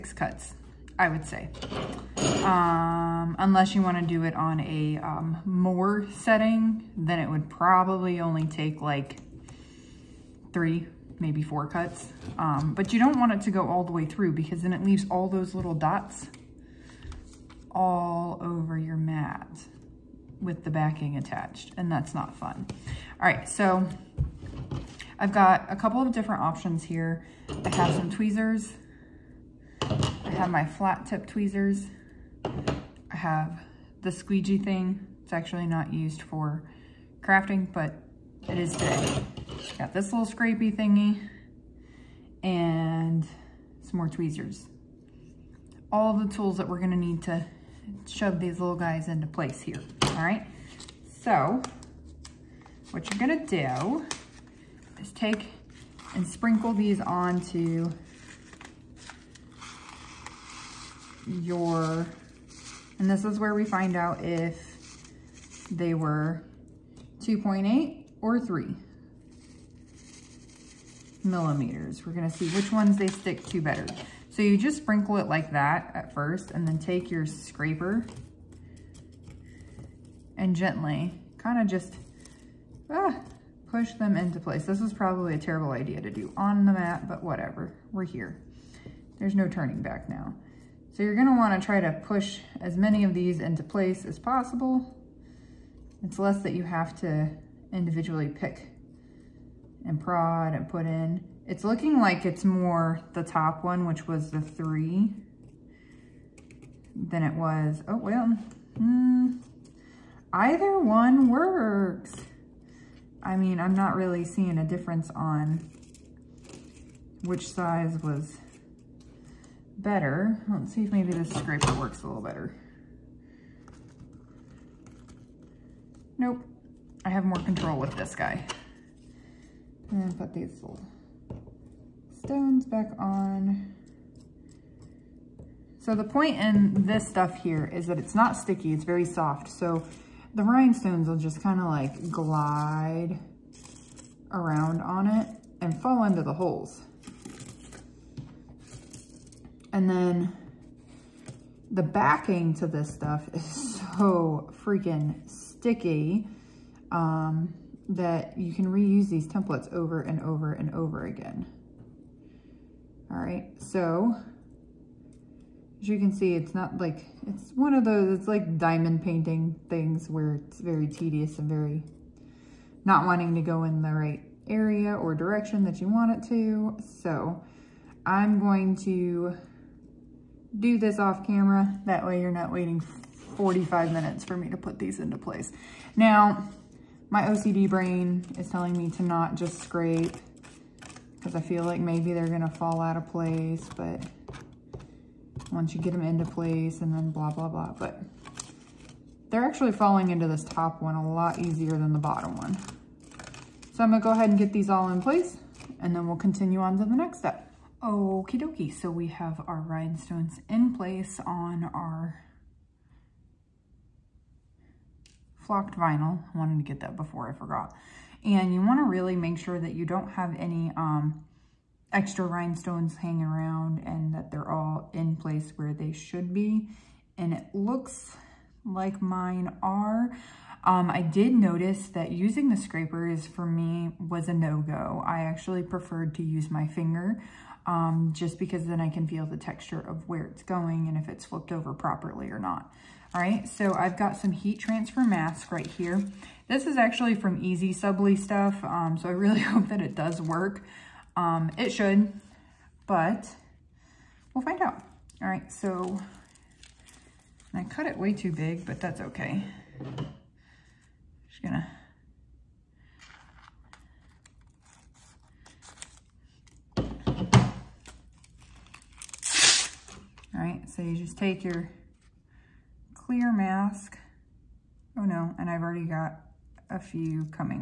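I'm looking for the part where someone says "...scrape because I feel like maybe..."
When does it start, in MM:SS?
03:09.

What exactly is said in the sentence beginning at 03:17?
But they're actually falling into this top one a lot easier than the bottom one.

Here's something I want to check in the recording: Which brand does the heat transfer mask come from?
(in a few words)
EasySubli.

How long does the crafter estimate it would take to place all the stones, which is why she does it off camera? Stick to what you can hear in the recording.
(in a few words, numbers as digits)
45 minutes.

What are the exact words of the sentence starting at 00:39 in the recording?
Got this little scrapey thingy and some more tweezers.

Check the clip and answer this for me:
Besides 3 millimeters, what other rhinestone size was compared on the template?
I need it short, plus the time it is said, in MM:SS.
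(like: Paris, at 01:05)
2.8 millimeters, at 01:07.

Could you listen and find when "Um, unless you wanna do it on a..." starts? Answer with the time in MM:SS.
00:02.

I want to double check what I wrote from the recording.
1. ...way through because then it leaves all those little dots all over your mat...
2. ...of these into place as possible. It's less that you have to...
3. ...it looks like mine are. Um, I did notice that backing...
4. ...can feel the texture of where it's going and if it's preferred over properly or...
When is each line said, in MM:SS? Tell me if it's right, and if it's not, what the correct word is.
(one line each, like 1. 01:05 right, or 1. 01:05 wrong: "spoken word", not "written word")
1. 00:13 right
2. 01:33 right
3. 03:47 wrong: "using", not "backing"
4. 03:58 wrong: "flipped", not "preferred".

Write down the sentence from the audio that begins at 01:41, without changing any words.
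It's looking like it's more the top one, which was the three, than it was, oh, well, hmm.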